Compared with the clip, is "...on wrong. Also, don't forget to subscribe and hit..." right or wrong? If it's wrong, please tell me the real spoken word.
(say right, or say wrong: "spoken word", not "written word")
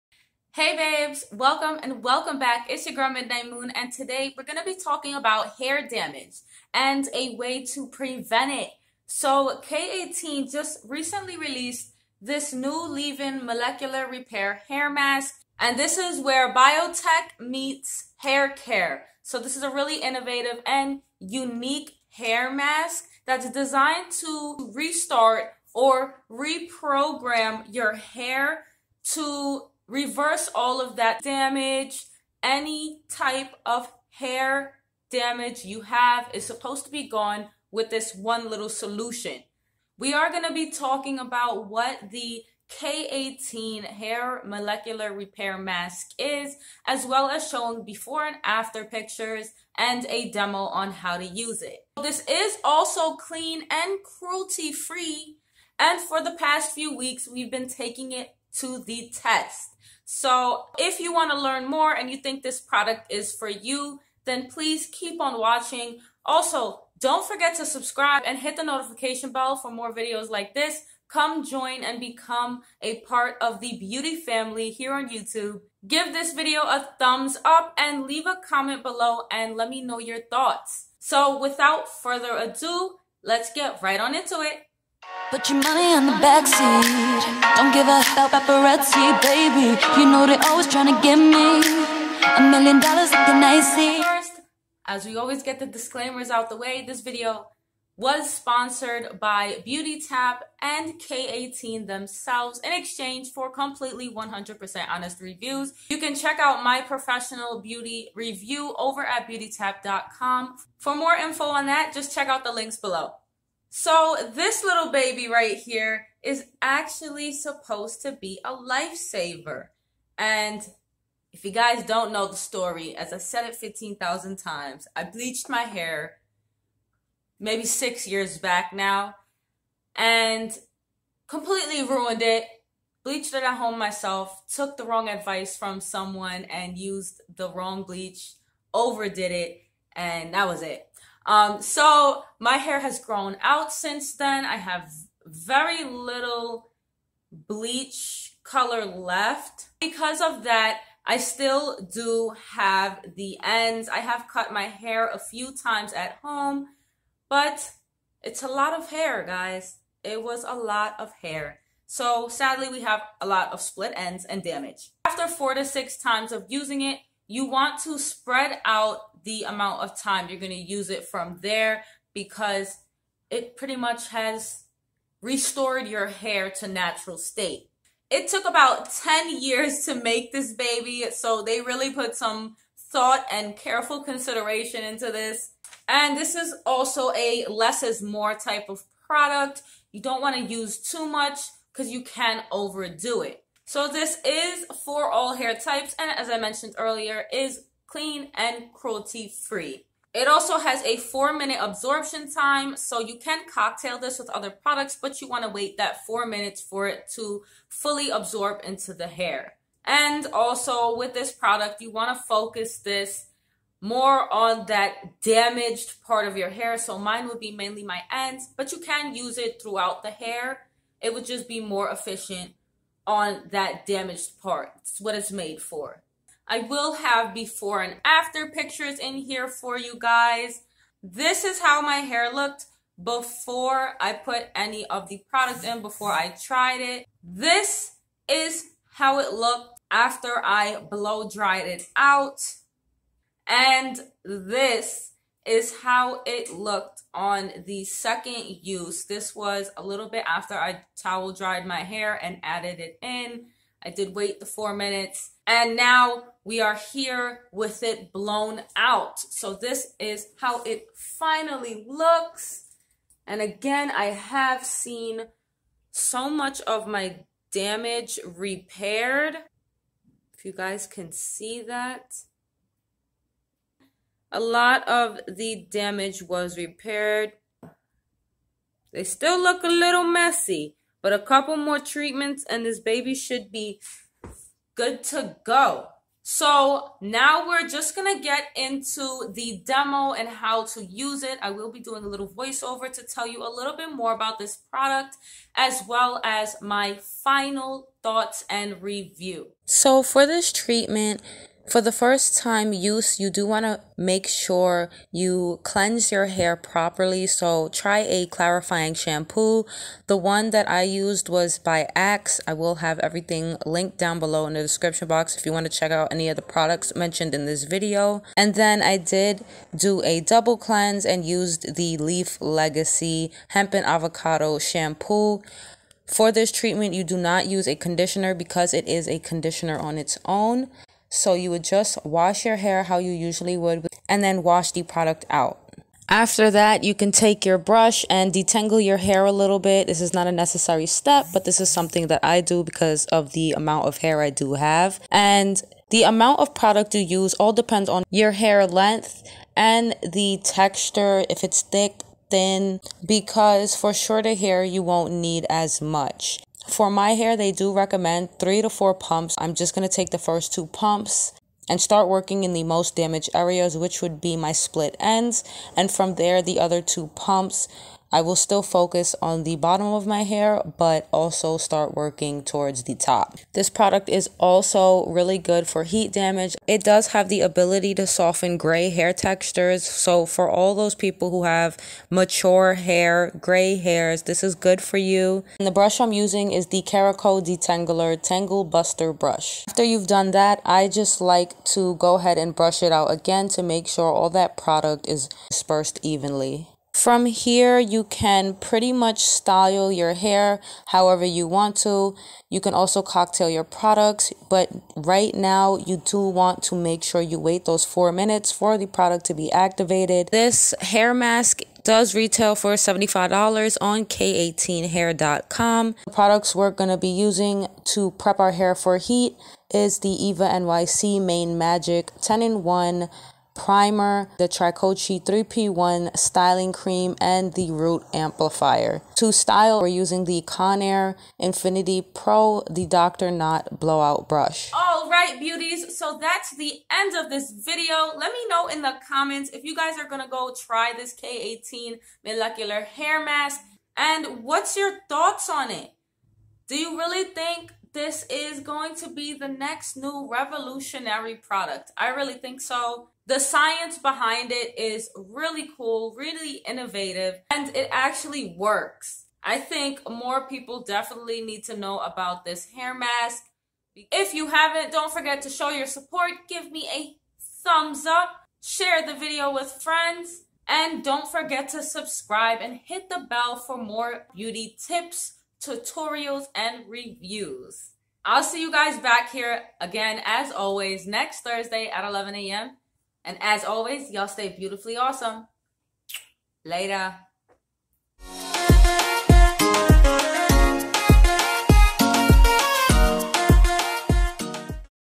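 wrong: "watching", not "wrong".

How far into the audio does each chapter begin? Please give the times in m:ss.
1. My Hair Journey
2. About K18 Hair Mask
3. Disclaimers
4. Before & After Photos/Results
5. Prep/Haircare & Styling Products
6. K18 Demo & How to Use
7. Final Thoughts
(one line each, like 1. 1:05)
1. 1:54
2. 2:45
3. 1:34
4. 3:47
5. 6:38
6. 5:00
7. 7:15.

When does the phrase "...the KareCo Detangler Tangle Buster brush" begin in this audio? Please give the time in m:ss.
6:26.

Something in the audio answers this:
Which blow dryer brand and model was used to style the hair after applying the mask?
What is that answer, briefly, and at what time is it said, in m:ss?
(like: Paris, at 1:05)
Conair Infinity Pro, at 7:10.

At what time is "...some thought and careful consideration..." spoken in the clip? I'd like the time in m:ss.
3:02.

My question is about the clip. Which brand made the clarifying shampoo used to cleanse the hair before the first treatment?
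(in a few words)
Axe.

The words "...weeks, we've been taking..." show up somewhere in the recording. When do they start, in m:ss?
0:56.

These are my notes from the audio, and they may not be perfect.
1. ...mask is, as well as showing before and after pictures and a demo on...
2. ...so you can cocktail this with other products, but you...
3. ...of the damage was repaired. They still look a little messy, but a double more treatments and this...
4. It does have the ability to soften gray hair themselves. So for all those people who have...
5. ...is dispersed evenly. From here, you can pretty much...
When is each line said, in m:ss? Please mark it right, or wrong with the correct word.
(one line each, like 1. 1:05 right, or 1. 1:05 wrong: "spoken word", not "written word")
1. 0:45 right
2. 3:22 right
3. 4:34 wrong: "couple", not "double"
4. 6:16 wrong: "textures", not "themselves"
5. 6:35 right.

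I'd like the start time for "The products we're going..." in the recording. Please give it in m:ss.
6:56.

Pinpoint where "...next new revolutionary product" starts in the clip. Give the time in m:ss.
7:29.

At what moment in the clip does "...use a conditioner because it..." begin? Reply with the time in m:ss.
5:27.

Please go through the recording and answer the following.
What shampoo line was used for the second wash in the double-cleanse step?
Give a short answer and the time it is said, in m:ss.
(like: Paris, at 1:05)
Leaf Legacy Hemp and Avocado, at 5:21.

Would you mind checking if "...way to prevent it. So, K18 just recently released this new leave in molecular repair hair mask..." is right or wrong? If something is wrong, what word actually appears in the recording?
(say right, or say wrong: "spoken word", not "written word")
right.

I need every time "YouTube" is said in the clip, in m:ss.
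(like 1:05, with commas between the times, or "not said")
1:15.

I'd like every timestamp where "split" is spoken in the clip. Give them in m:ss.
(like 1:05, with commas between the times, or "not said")
2:43, 6:04.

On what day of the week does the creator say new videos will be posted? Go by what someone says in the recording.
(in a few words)
Thursday.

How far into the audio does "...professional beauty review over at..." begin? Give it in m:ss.
1:46.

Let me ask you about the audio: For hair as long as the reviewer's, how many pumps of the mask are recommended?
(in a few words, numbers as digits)
3 to 4 pumps.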